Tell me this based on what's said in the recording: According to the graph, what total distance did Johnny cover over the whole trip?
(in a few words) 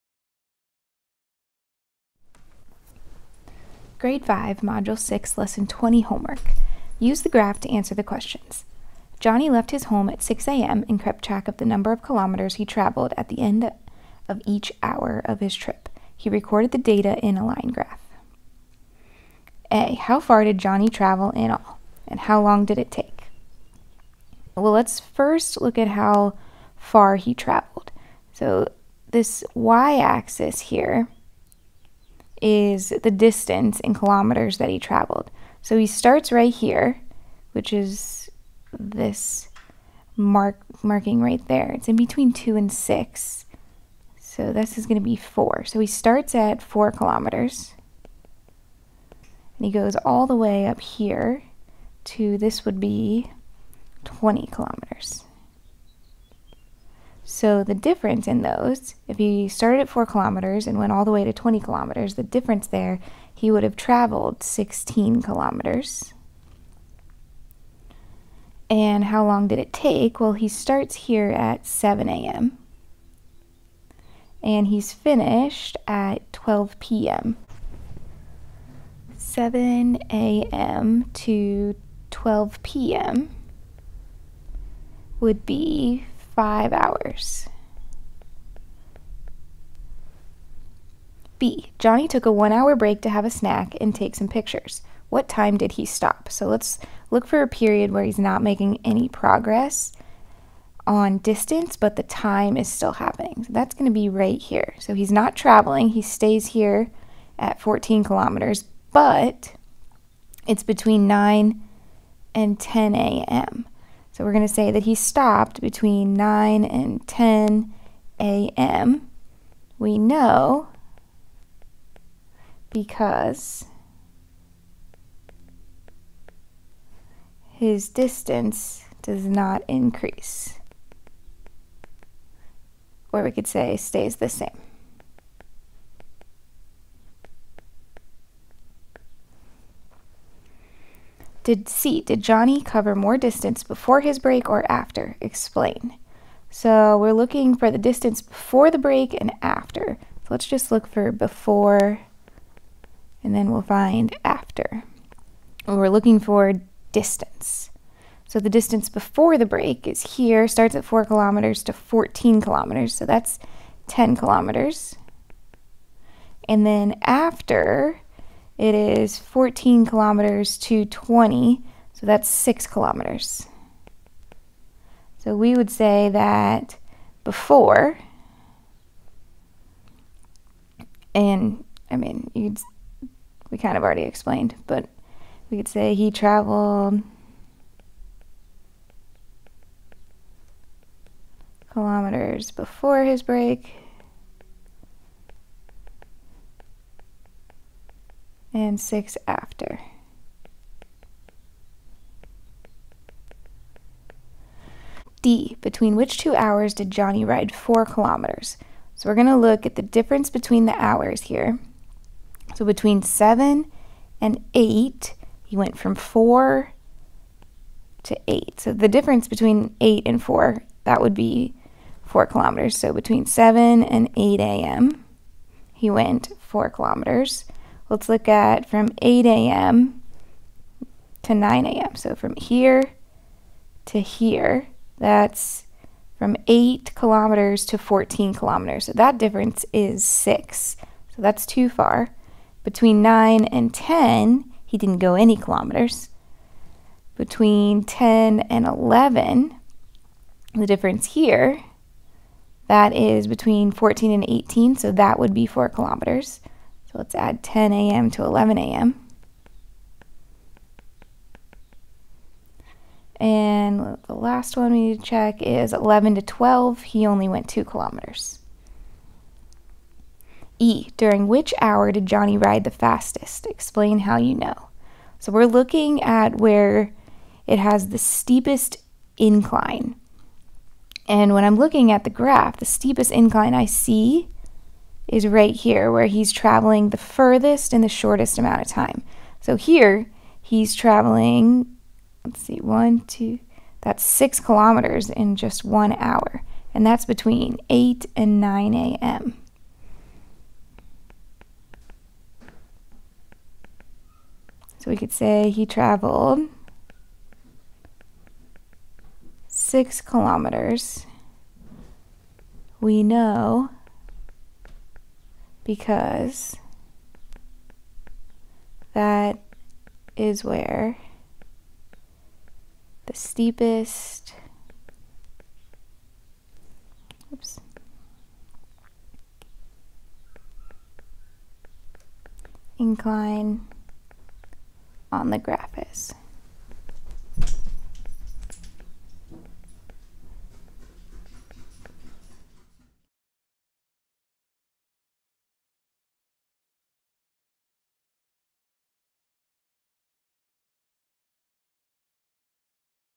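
16 kilometers.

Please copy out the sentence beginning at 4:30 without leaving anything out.
During which hour did Johnny ride the fastest?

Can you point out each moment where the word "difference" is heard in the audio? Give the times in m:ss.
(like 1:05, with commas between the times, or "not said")
0:57, 1:02, 3:29, 3:38, 3:59, 4:10.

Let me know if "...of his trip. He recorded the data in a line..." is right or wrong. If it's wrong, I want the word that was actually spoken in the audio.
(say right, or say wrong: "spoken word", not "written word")
right.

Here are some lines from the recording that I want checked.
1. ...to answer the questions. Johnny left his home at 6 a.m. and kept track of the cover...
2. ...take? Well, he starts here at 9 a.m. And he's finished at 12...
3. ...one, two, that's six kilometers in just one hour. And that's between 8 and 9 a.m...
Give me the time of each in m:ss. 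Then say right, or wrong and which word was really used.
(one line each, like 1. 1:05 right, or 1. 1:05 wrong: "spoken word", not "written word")
1. 0:07 wrong: "number", not "cover"
2. 1:09 wrong: "7", not "9"
3. 4:52 right.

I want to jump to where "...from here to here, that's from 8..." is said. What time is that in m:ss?
3:52.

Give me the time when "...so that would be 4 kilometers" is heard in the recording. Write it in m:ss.
4:14.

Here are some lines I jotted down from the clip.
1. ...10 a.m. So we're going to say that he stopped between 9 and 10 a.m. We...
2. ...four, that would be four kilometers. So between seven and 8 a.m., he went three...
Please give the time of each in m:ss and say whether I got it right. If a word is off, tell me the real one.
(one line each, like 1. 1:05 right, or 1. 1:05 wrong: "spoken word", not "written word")
1. 1:52 right
2. 3:40 wrong: "four", not "three".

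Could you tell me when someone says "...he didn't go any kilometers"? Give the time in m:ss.
4:04.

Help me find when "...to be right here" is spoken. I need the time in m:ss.
1:43.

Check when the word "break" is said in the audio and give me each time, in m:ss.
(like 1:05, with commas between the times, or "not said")
1:32, 2:24, 2:28, 2:39, 3:13.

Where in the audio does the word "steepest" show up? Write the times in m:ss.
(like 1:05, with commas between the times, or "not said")
4:37, 4:42, 5:23.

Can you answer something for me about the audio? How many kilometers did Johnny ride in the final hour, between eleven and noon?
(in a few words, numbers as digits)
2 kilometers.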